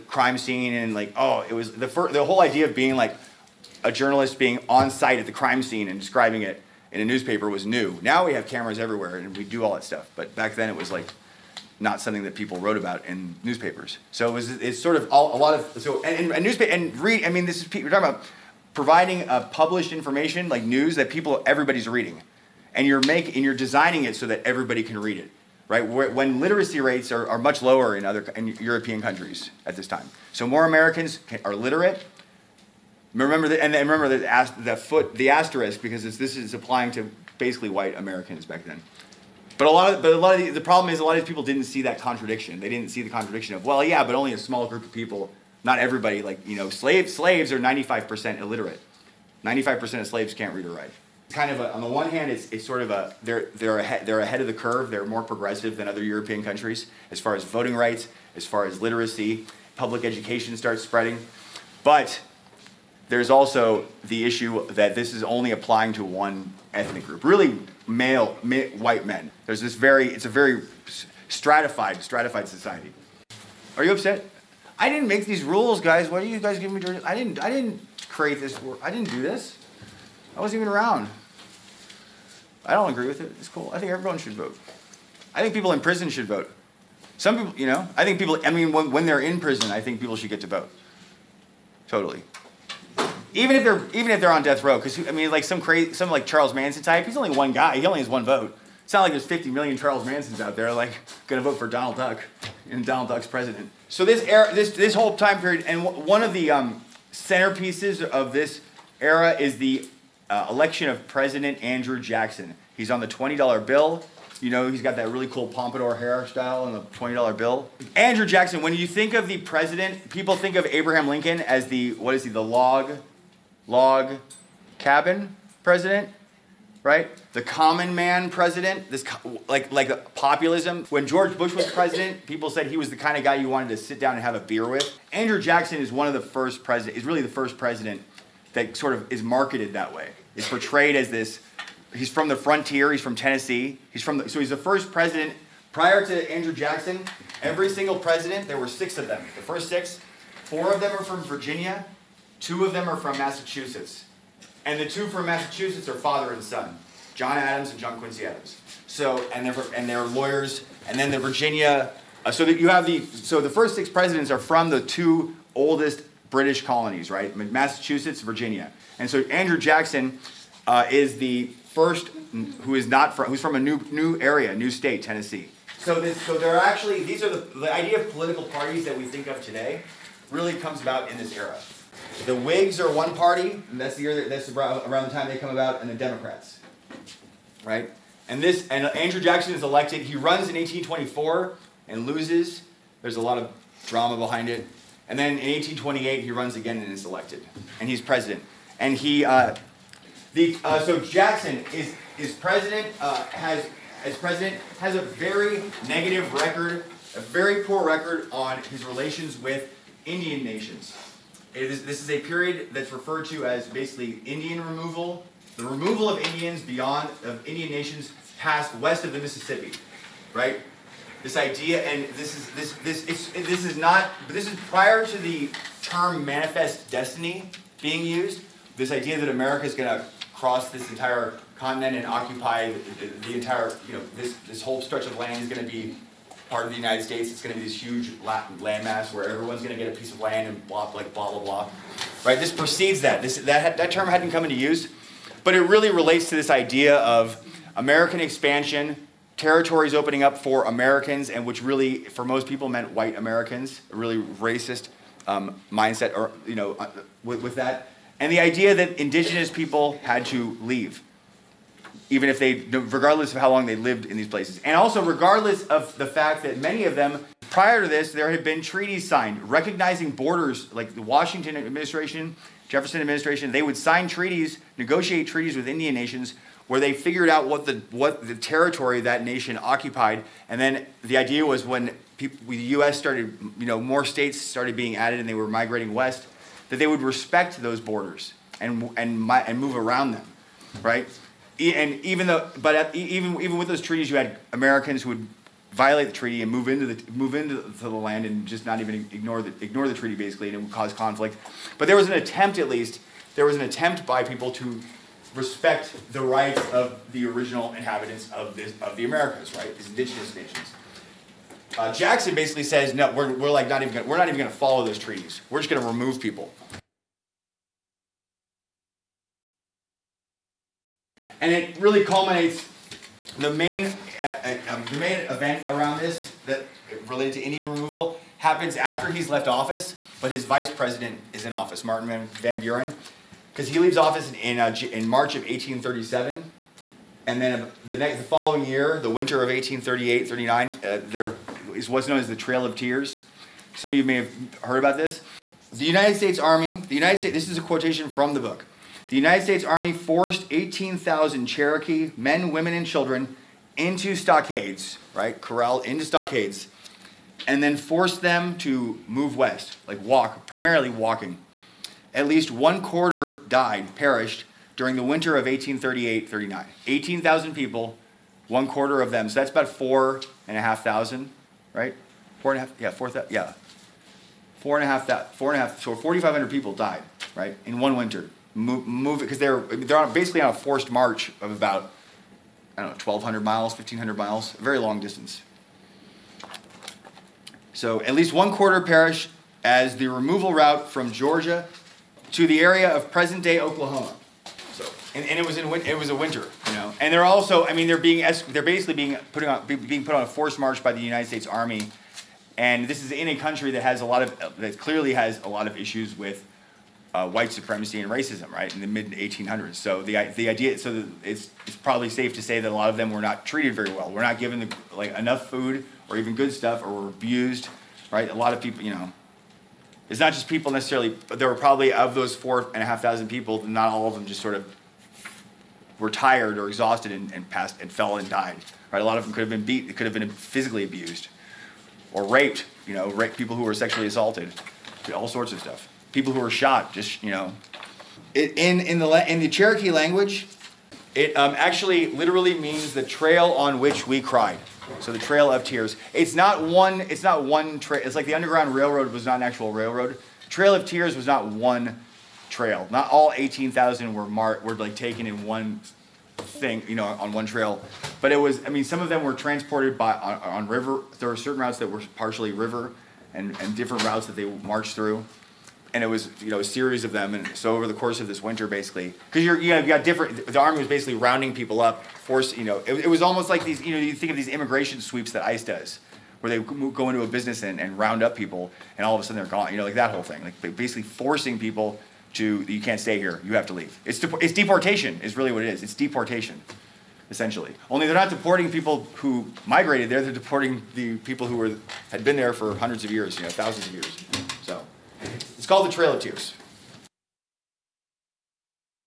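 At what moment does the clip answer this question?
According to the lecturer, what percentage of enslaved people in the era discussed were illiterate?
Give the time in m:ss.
0:49.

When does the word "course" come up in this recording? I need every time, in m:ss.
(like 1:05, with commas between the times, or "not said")
7:47.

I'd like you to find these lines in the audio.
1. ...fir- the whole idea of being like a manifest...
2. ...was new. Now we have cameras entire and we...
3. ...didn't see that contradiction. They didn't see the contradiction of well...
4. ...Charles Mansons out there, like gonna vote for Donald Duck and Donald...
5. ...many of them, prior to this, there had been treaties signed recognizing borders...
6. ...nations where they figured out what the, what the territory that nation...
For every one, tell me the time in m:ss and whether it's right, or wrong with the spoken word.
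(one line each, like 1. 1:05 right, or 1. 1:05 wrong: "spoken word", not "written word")
1. 0:01 wrong: "journalist", not "manifest"
2. 0:07 wrong: "everywhere", not "entire"
3. 0:41 right
4. 1:39 right
5. 4:26 right
6. 4:35 right.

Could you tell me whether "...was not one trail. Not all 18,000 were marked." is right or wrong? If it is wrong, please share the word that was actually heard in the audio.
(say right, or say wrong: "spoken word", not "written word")
right.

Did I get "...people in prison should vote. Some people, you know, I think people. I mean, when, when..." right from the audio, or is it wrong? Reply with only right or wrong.
right.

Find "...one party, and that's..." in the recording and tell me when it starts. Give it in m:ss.
3:02.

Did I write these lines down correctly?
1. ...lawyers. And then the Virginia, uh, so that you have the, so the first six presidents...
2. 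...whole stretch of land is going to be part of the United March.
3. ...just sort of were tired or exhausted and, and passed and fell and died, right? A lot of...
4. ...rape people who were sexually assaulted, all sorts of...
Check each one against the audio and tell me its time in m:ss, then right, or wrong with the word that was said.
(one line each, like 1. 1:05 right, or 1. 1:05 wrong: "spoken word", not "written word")
1. 2:40 right
2. 3:54 wrong: "States", not "March"
3. 7:04 right
4. 7:13 right.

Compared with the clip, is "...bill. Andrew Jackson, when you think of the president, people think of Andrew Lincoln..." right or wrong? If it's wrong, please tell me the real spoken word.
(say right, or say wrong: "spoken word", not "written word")
wrong: "Abraham", not "Andrew".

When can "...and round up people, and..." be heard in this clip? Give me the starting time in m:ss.
7:57.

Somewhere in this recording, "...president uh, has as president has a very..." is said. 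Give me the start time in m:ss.
3:22.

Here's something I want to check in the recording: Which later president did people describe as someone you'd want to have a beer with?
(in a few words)
George Bush.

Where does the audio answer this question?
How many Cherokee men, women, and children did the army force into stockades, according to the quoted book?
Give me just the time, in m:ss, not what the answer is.
5:50.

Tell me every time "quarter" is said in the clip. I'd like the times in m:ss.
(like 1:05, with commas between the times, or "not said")
6:02, 6:08, 6:28.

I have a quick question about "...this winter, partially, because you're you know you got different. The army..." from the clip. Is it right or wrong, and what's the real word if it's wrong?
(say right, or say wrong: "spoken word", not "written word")
wrong: "basically", not "partially".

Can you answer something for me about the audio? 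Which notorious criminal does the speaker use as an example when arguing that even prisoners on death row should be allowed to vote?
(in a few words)
Charles Manson.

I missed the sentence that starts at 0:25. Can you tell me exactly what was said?
When literacy rates are, are much lower in other in European countries at this time, so more Americans can, are literate.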